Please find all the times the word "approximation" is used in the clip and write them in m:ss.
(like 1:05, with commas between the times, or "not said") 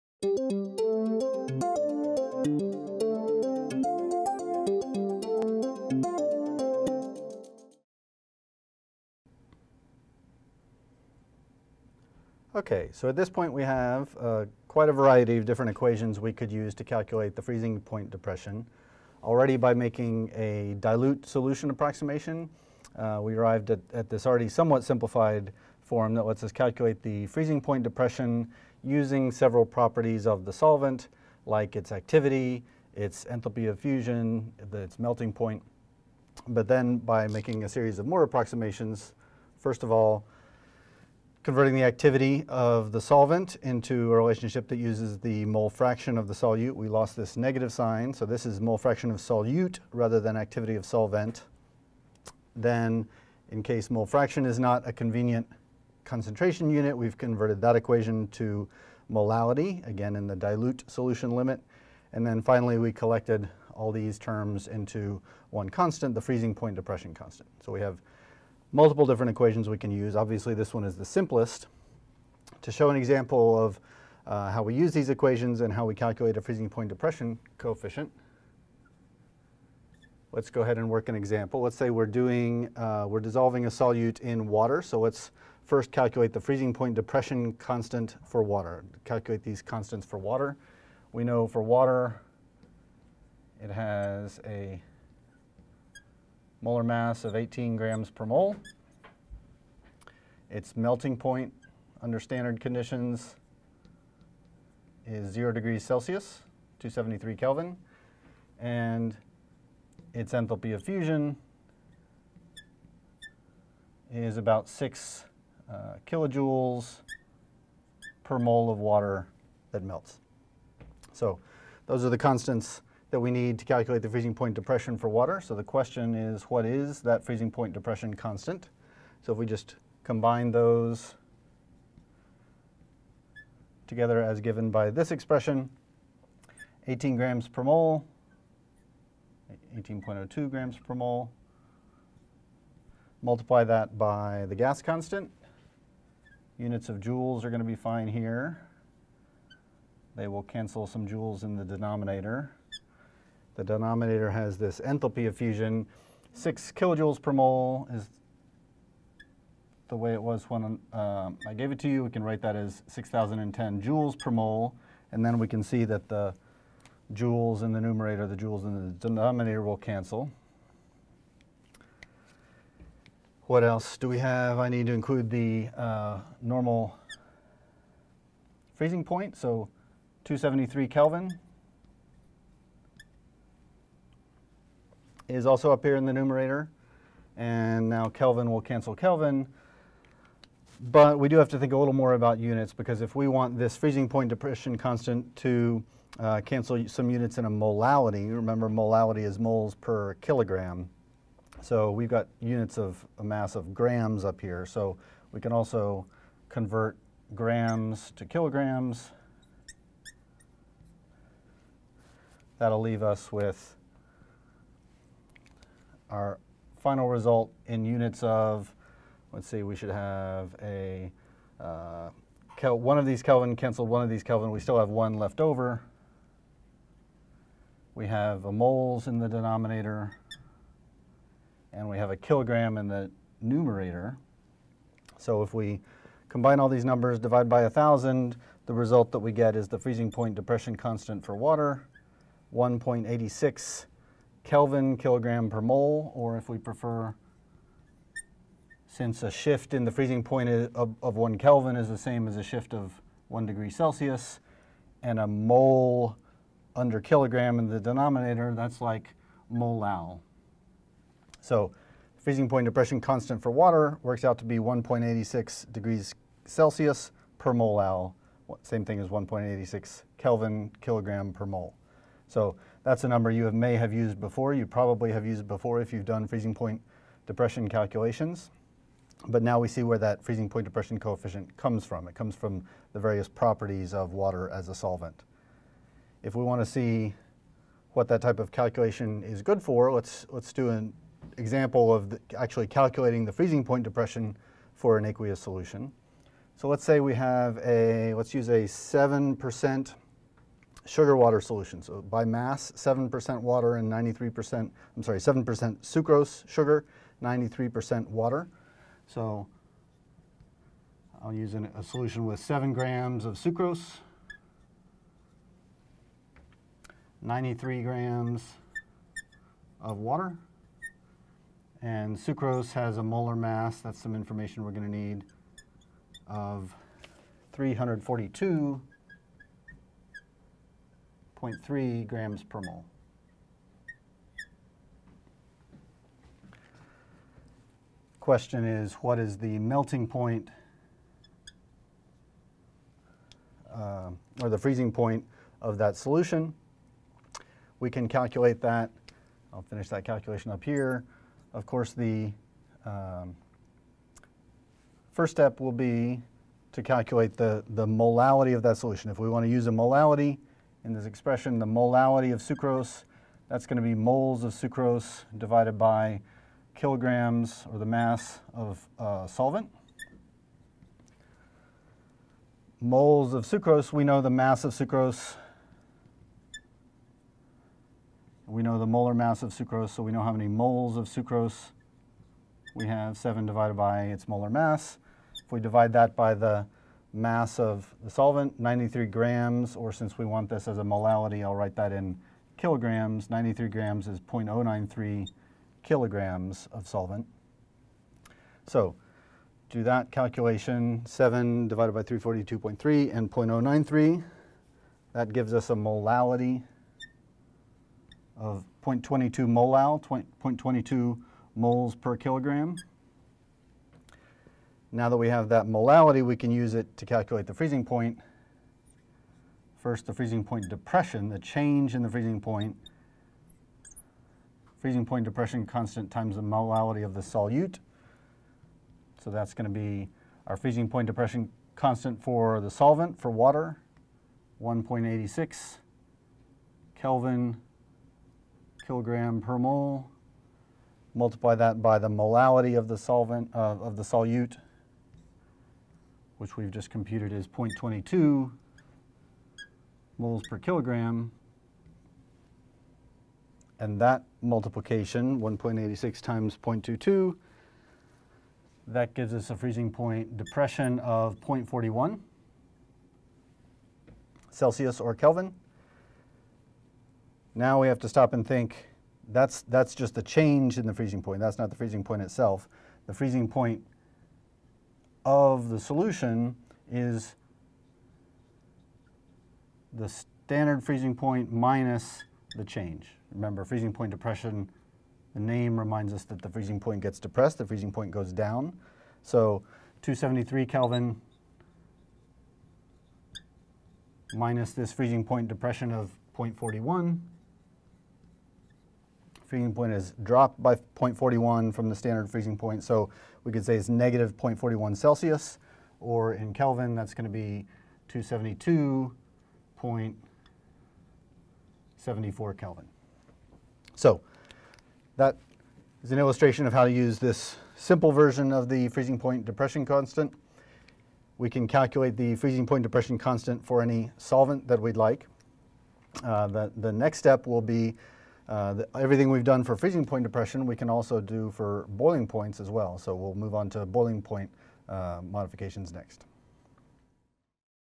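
0:21, 0:38.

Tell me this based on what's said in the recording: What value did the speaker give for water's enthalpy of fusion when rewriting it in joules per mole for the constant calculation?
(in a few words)
6,010 joules per mole.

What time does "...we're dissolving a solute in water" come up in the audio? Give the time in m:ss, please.
1:23.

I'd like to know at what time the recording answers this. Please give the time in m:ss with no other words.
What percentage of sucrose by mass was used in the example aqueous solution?
5:05.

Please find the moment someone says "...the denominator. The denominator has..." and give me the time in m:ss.
2:31.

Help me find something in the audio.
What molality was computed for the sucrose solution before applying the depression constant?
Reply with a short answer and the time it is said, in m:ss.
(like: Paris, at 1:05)
0.22 molal, at 6:48.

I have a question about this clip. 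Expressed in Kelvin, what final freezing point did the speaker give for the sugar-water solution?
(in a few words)
272.74 Kelvin.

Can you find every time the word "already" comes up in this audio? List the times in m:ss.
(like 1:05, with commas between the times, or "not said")
0:19, 0:24.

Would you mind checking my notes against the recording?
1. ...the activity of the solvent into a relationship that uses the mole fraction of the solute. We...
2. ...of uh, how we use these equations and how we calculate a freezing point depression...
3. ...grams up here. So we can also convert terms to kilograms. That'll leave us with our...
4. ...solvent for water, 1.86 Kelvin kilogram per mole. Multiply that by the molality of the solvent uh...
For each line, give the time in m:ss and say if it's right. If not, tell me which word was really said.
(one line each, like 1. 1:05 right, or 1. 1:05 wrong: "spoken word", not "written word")
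1. 0:41 right
2. 1:13 right
3. 3:23 wrong: "grams", not "terms"
4. 7:12 right.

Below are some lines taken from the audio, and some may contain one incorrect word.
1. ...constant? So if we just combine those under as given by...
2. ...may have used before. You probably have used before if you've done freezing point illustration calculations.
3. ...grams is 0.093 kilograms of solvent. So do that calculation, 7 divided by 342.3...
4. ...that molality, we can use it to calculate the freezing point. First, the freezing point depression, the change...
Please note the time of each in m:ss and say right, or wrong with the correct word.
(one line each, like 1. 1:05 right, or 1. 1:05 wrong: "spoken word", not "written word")
1. 2:08 wrong: "together", not "under"
2. 4:33 wrong: "depression", not "illustration"
3. 6:33 right
4. 6:55 right.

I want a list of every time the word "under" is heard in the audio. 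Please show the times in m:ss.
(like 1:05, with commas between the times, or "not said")
1:42, 4:16.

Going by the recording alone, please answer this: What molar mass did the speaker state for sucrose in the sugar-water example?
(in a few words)
342.3 grams per mole.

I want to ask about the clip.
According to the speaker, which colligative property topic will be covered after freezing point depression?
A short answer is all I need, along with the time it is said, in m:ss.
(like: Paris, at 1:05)
boiling points, at 8:51.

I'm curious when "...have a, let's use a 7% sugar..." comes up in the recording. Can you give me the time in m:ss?
4:57.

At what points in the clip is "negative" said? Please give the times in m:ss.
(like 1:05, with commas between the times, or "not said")
0:47, 8:23.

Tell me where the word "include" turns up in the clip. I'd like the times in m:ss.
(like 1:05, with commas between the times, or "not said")
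2:54.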